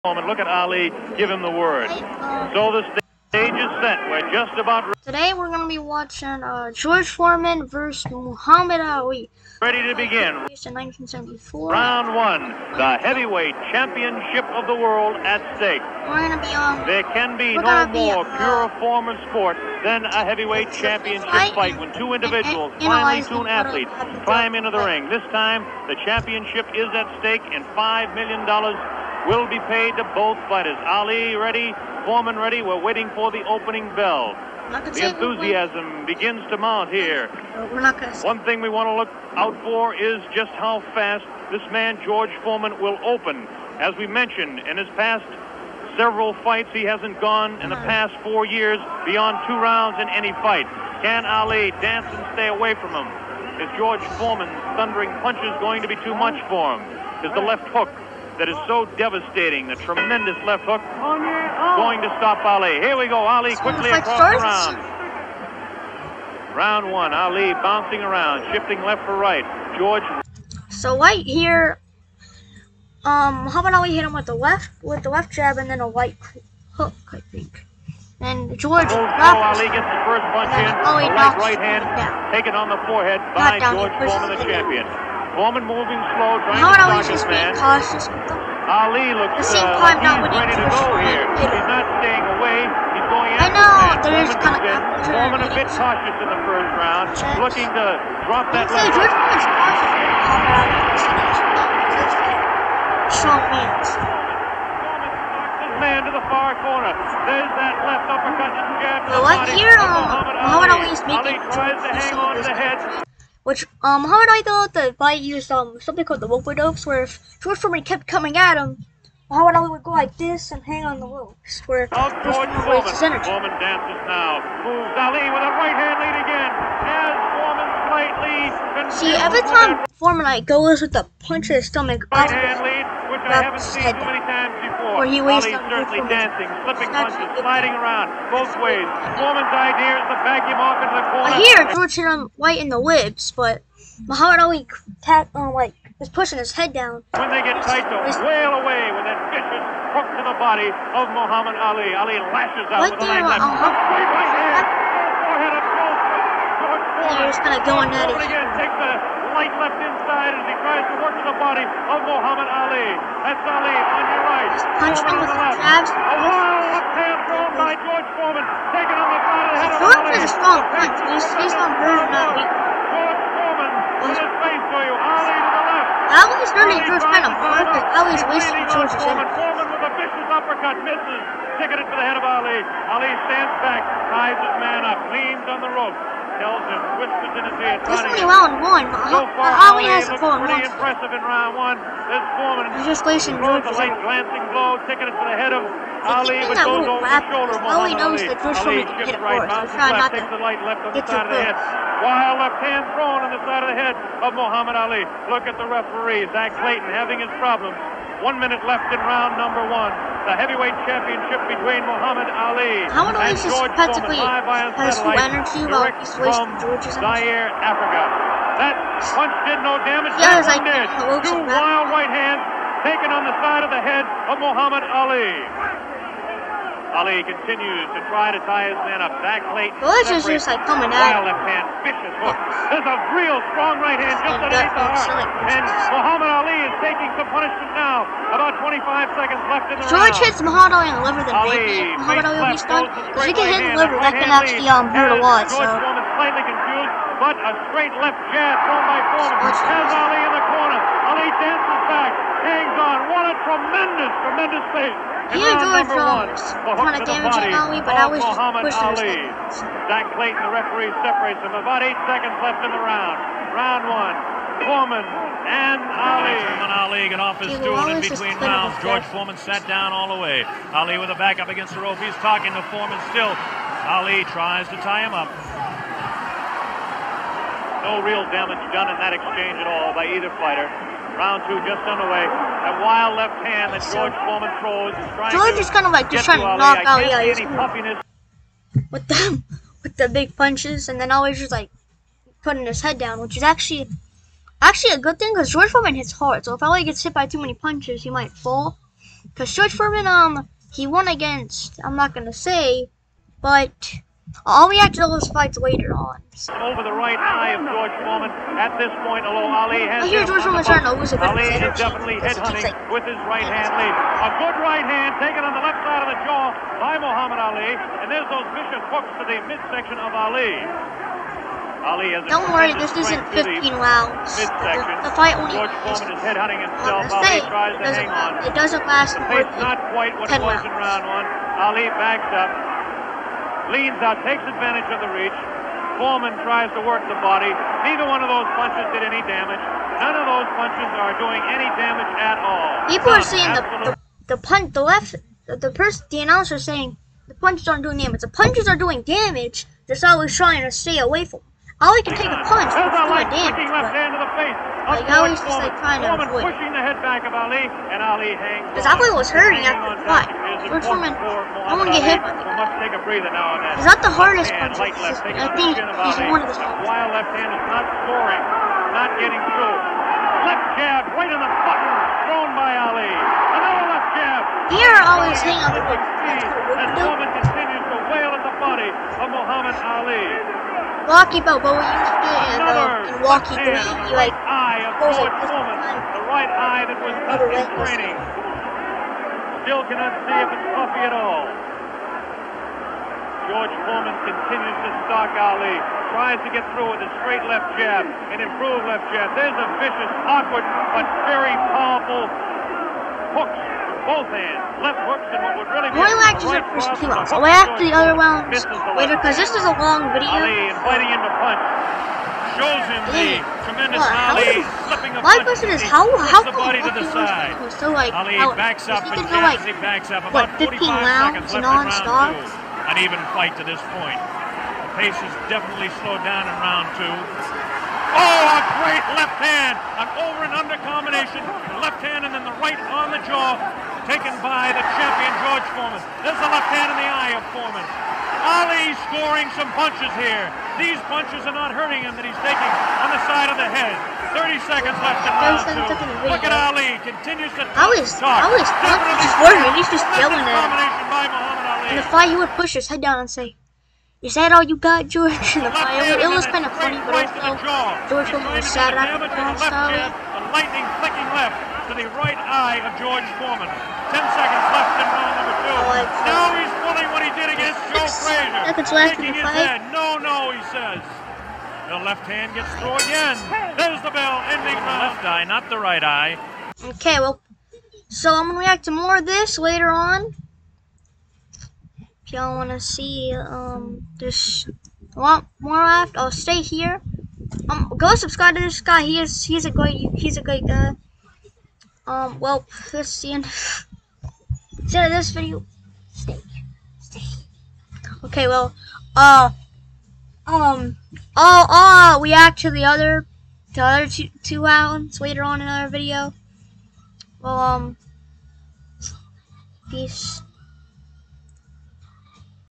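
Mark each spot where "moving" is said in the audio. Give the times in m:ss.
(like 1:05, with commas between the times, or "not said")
1:25, 2:51.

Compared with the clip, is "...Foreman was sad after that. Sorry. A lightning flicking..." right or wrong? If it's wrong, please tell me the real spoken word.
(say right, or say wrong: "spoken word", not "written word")
right.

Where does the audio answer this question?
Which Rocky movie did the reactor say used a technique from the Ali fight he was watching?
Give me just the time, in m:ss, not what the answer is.
6:23.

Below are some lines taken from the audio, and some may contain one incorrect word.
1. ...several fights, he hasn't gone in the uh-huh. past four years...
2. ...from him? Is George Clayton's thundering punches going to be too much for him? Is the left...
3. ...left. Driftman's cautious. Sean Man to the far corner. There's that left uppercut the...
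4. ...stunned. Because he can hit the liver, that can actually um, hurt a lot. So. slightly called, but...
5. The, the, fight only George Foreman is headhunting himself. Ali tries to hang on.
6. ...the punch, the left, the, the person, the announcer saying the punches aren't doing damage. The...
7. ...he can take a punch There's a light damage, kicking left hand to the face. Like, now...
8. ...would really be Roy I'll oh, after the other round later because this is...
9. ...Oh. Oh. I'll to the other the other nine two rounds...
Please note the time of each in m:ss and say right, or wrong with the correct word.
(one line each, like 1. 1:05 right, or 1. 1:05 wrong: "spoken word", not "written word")
1. 0:45 right
2. 0:52 wrong: "Foreman", not "Clayton"
3. 1:38 right
4. 4:02 wrong: "confused", not "called"
5. 5:24 right
6. 5:44 right
7. 5:51 right
8. 6:45 right
9. 8:21 wrong: "two", not "nine".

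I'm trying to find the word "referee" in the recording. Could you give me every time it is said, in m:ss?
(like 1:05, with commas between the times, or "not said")
3:25, 4:20.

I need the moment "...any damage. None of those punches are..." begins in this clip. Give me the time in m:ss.
5:39.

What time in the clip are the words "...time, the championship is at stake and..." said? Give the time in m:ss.
0:25.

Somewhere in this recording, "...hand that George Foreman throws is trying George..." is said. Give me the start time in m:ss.
4:43.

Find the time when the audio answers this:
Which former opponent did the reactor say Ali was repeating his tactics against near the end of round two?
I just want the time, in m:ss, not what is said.
7:47.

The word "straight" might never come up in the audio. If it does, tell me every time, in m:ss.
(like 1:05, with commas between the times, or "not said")
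4:07, 6:37.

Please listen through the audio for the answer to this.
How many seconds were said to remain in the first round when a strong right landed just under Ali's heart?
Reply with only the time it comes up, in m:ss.
3:58.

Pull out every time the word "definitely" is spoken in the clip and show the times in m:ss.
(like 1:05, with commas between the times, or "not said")
5:11, 7:05.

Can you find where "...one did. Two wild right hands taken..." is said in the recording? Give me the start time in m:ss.
3:40.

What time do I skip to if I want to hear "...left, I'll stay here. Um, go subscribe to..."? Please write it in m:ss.
8:05.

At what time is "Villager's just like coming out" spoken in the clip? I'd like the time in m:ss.
3:49.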